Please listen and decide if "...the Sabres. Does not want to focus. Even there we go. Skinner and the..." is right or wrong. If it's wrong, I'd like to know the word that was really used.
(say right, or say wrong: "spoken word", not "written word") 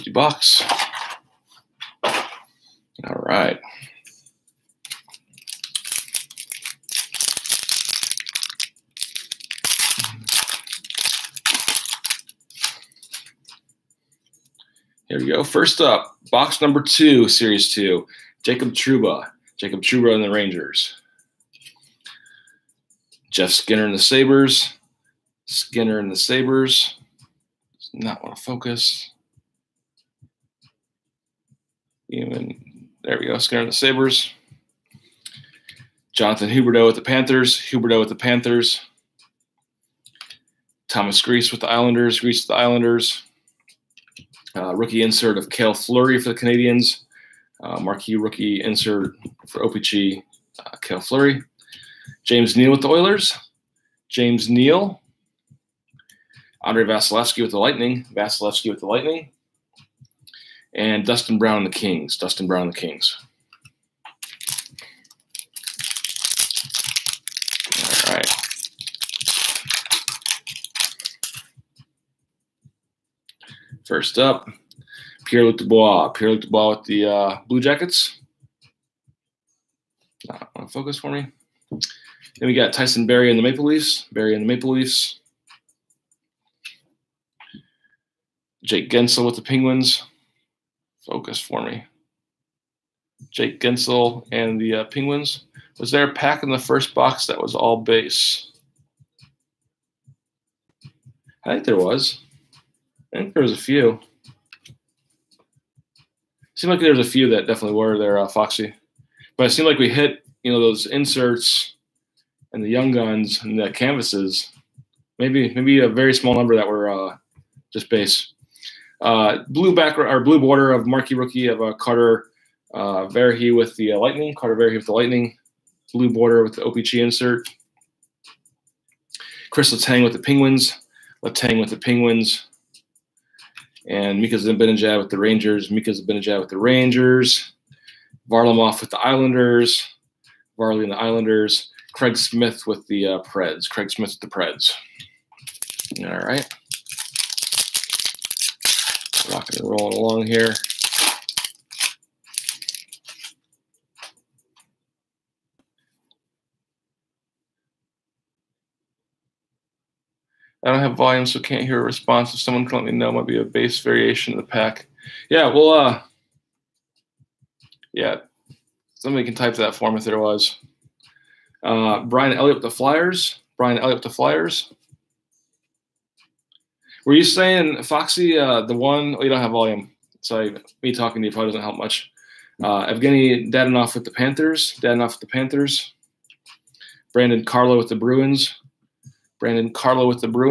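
right.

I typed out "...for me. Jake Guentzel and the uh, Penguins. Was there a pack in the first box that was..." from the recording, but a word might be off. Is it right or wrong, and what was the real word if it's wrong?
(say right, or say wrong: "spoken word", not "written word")
right.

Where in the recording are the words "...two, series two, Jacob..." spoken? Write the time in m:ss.
0:16.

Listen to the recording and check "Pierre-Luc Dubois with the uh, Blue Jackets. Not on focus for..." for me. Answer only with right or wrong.
right.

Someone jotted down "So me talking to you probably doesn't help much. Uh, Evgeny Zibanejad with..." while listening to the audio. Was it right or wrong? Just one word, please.
wrong.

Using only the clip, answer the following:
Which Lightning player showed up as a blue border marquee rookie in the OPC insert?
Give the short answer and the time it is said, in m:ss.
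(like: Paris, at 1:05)
Carter Verhaeghe, at 2:04.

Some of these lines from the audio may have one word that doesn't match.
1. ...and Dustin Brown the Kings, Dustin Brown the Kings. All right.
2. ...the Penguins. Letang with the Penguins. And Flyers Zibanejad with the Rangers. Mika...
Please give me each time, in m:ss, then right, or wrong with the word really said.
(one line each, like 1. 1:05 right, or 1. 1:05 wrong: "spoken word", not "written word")
1. 1:00 right
2. 2:10 wrong: "Mika", not "Flyers".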